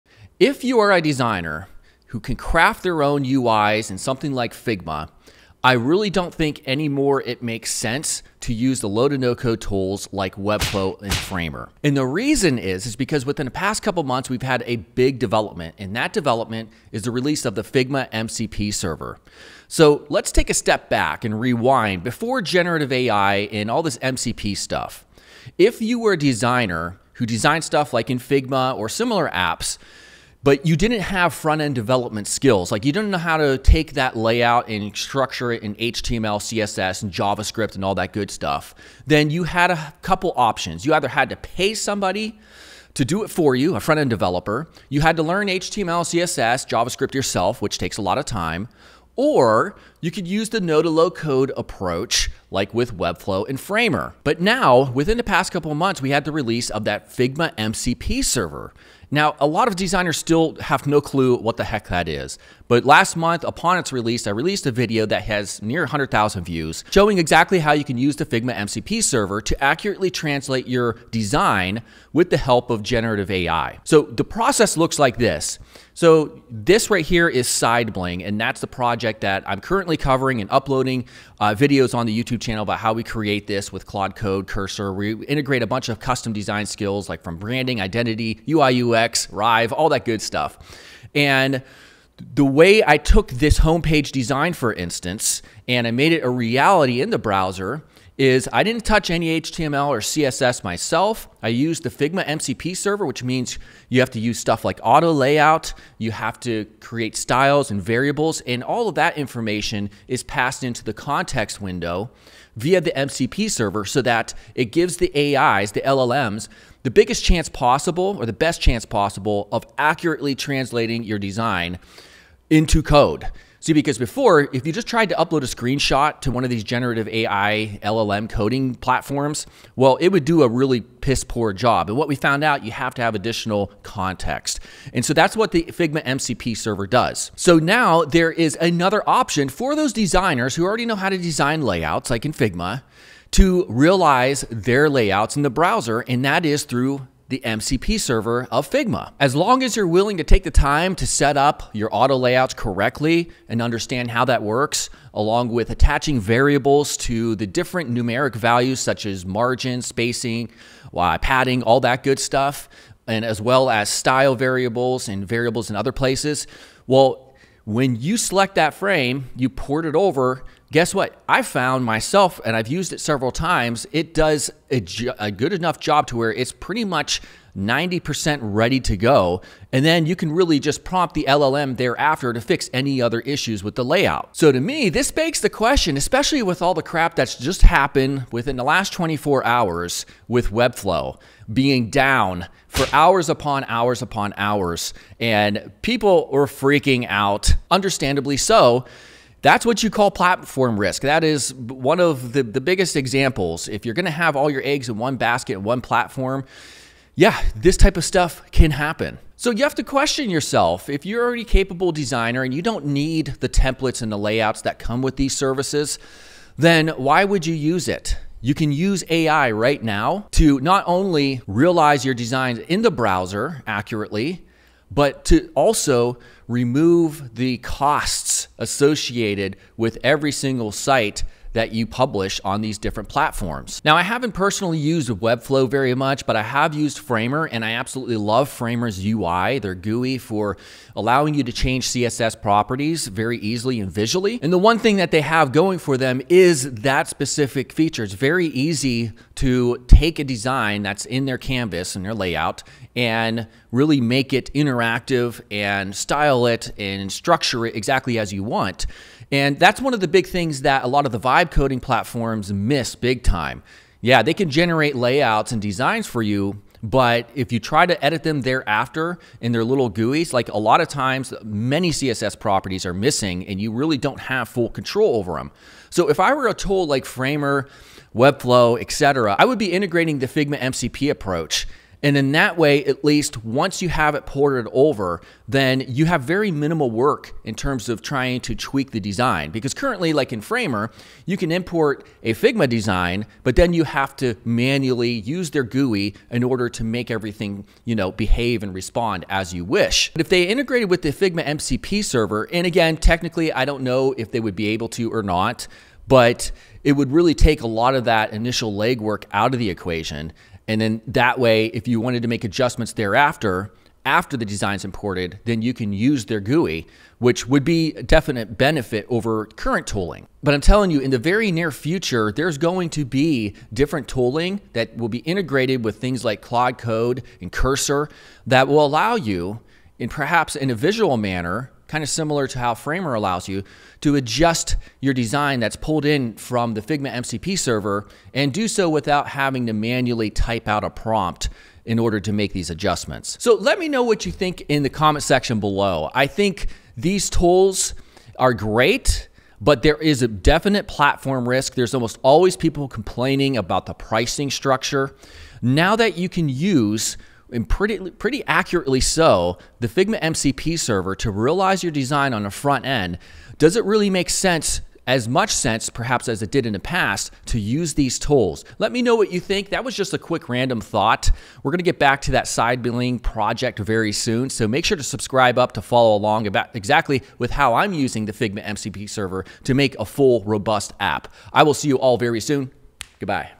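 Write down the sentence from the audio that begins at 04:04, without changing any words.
And the one thing that they have going for them is that specific feature.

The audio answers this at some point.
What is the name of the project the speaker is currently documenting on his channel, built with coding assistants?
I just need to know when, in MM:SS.
01:17.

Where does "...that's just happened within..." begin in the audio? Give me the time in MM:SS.
03:07.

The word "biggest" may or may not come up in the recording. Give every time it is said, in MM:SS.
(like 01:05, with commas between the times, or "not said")
01:56, 03:22.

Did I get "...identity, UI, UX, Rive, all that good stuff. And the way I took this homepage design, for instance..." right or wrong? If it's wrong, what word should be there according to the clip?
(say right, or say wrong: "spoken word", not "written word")
right.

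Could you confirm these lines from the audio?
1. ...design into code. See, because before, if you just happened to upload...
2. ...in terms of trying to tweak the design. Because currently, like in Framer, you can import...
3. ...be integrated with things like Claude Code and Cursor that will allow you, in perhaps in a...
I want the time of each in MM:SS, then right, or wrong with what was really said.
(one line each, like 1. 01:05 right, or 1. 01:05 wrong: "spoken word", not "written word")
1. 02:01 wrong: "tried", not "happened"
2. 04:47 right
3. 05:25 right.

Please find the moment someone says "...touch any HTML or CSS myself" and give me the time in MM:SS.
01:38.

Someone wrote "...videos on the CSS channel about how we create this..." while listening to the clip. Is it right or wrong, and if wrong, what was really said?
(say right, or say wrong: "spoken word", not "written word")
wrong: "YouTube", not "CSS".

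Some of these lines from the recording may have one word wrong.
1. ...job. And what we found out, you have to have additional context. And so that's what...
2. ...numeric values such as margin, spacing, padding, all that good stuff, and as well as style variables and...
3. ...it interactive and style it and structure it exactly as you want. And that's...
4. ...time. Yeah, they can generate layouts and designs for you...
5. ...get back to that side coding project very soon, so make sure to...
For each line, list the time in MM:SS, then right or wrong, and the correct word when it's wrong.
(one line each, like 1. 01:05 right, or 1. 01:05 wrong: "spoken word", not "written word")
1. 02:11 right
2. 02:37 right
3. 04:14 right
4. 04:23 right
5. 06:11 wrong: "billing", not "coding".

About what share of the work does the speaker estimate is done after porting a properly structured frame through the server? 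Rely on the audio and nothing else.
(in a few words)
90%.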